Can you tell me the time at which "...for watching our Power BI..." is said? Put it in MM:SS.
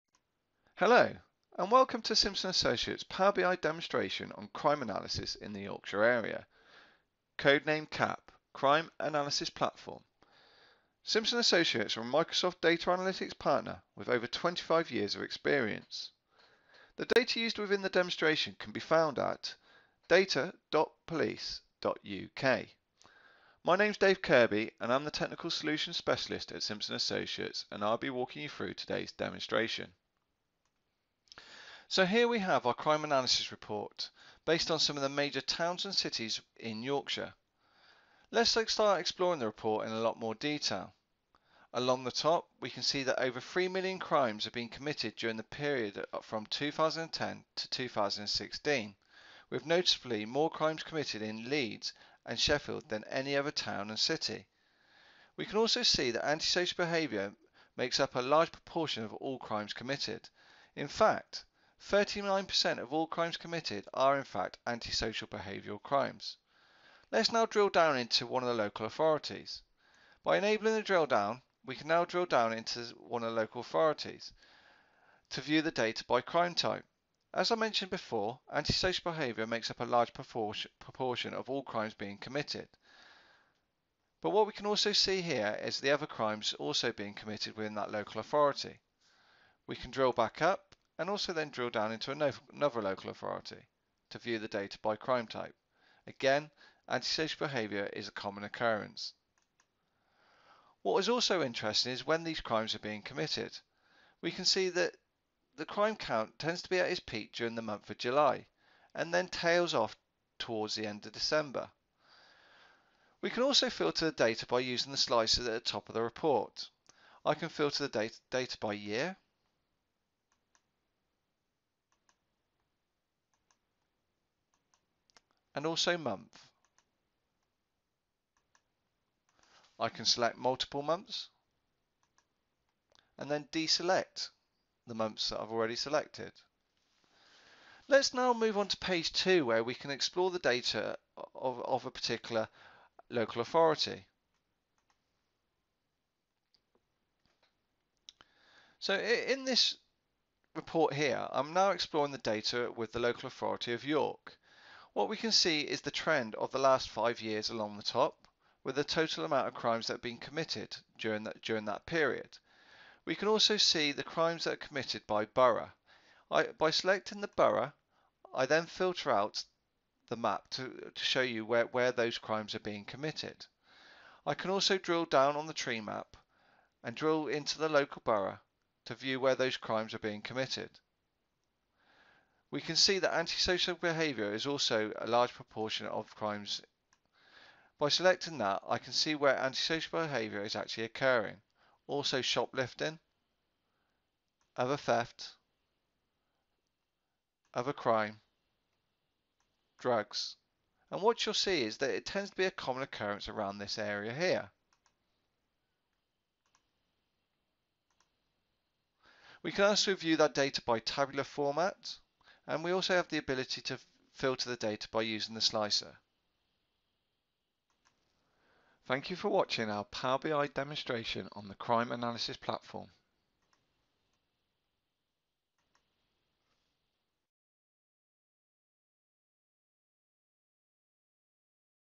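03:39.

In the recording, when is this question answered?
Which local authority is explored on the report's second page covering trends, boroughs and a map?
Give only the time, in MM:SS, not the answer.
02:33.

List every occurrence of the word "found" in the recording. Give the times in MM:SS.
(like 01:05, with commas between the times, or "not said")
00:18.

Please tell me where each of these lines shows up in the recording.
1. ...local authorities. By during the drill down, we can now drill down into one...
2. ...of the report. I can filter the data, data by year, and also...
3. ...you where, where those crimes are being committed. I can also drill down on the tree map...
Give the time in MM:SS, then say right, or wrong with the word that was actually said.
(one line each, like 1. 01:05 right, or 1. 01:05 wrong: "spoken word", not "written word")
1. 01:08 wrong: "enabling", not "during"
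2. 01:55 right
3. 02:51 right.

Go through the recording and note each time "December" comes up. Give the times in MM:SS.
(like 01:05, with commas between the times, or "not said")
01:51.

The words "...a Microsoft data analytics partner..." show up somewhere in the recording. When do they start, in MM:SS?
00:12.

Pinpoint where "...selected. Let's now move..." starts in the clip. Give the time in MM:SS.
02:15.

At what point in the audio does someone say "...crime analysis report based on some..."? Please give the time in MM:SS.
00:32.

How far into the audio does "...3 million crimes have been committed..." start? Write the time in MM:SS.
00:43.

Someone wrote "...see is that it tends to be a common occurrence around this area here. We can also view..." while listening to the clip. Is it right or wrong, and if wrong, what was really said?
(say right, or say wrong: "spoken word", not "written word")
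right.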